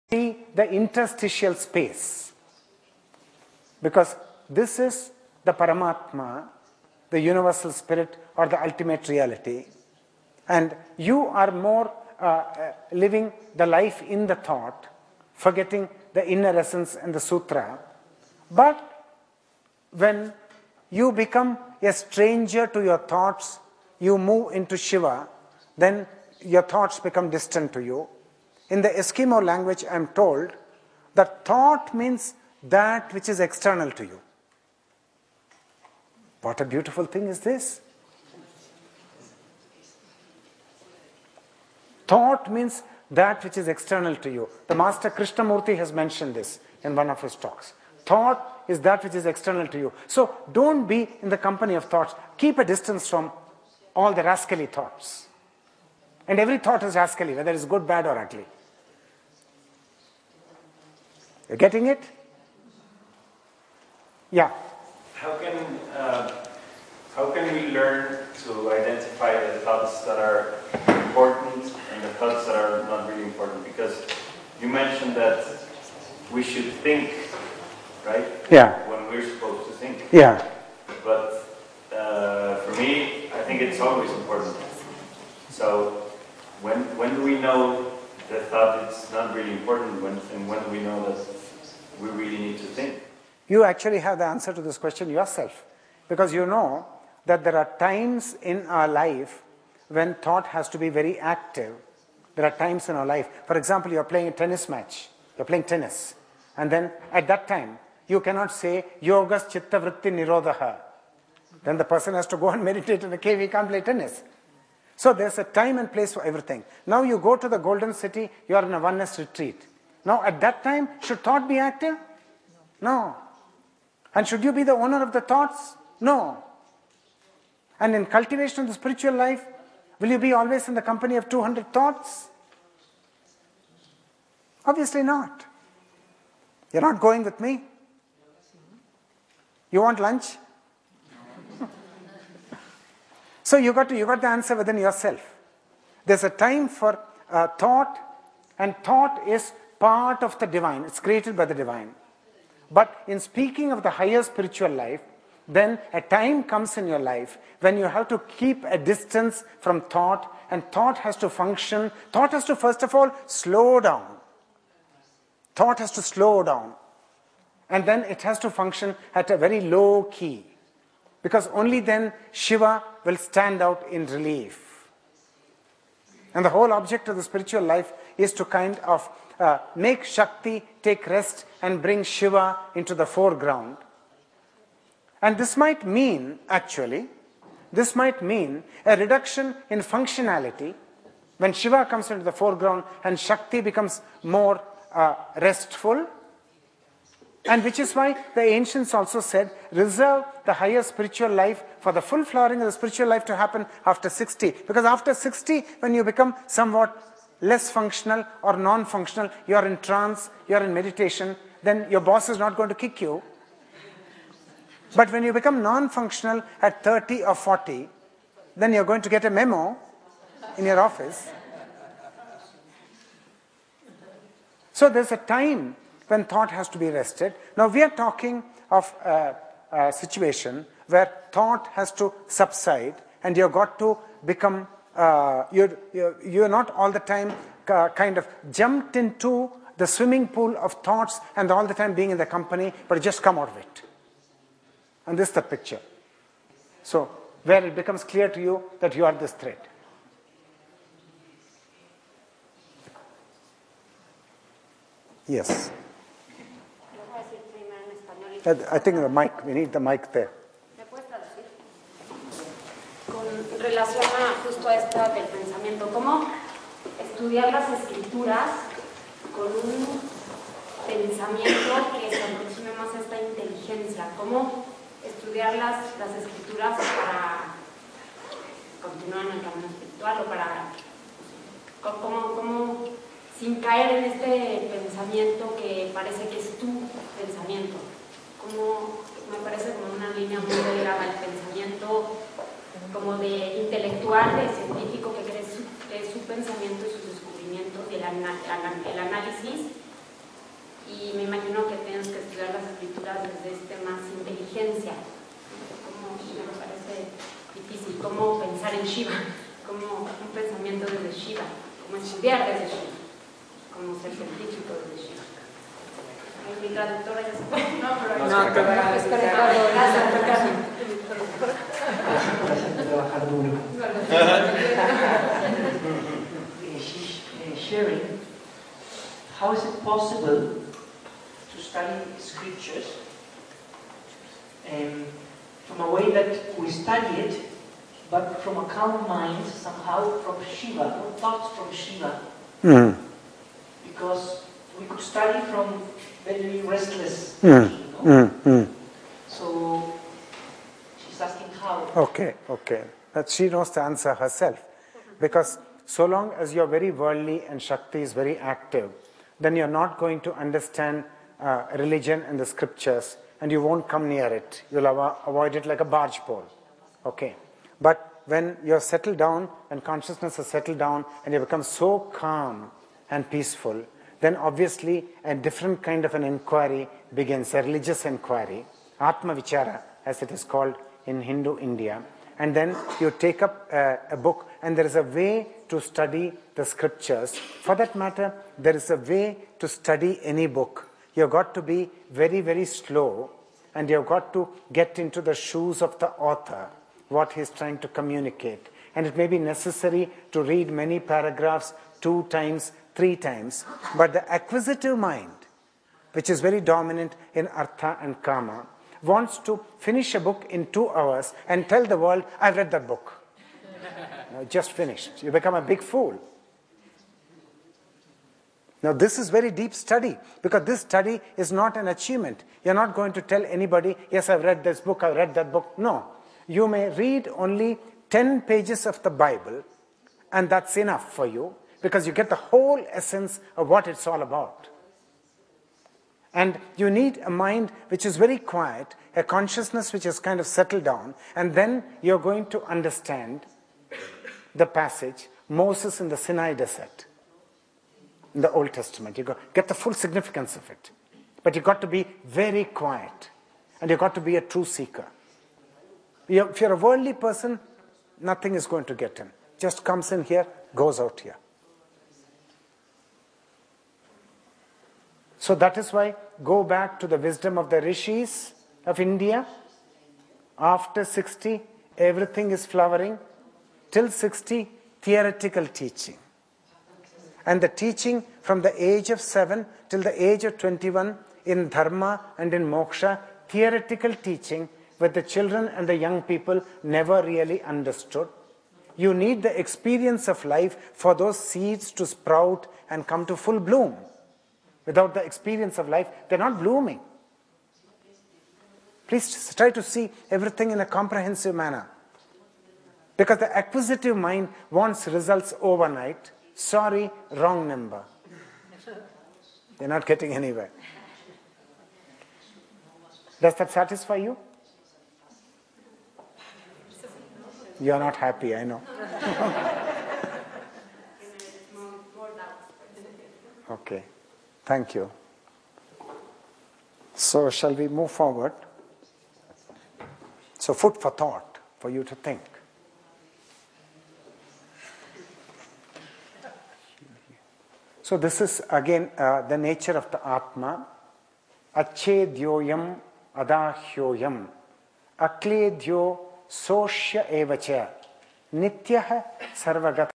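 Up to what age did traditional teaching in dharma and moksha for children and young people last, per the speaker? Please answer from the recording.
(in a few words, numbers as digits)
21.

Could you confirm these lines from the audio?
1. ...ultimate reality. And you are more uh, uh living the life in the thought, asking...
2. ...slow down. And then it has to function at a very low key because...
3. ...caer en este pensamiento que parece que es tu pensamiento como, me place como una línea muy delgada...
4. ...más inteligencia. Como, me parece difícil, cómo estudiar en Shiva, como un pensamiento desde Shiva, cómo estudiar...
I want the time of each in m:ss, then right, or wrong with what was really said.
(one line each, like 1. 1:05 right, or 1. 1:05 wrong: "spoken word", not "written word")
1. 0:08 wrong: "forgetting", not "asking"
2. 2:46 right
3. 4:43 wrong: "parece", not "place"
4. 5:03 wrong: "pensar", not "estudiar".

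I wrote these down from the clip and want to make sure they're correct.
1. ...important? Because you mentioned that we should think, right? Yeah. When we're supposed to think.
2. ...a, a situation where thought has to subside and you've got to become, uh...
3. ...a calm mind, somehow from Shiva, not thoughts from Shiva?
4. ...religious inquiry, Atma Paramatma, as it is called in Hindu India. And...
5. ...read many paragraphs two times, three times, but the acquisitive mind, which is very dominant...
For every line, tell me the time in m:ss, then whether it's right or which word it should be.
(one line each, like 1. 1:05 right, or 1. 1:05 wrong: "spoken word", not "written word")
1. 1:13 right
2. 3:49 right
3. 5:38 right
4. 6:17 wrong: "Vichara", not "Paramatma"
5. 6:40 right.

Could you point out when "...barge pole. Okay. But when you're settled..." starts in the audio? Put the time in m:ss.
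6:05.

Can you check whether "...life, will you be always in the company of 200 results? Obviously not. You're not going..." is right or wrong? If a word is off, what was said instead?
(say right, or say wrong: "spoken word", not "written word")
wrong: "thoughts", not "results".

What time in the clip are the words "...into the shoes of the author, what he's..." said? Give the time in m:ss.
6:34.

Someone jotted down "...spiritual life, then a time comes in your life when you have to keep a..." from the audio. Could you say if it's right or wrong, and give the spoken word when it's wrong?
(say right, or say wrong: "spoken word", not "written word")
right.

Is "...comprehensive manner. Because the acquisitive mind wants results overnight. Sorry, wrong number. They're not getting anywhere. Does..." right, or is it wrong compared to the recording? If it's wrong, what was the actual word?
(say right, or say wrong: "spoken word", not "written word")
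right.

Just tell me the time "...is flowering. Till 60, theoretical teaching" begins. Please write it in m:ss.
7:52.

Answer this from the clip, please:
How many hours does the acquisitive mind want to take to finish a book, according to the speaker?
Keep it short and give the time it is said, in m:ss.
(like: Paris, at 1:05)
2, at 6:50.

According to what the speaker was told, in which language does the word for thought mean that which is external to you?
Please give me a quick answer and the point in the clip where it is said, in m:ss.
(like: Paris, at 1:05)
Eskimo, at 0:28.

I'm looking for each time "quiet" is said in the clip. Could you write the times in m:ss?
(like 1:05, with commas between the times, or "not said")
7:18, 7:32.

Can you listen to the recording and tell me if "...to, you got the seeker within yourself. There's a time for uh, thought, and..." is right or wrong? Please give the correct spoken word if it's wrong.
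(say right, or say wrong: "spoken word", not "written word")
wrong: "answer", not "seeker".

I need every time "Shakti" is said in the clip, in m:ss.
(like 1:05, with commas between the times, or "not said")
3:00, 3:13, 5:57.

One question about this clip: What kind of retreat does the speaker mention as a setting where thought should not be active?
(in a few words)
Oneness retreat.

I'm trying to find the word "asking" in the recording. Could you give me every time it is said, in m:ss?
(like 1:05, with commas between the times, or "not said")
5:51.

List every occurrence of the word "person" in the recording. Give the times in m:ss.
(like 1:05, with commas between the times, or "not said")
1:51, 7:37.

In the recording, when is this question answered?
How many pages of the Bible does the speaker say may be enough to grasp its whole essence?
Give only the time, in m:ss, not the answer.
7:08.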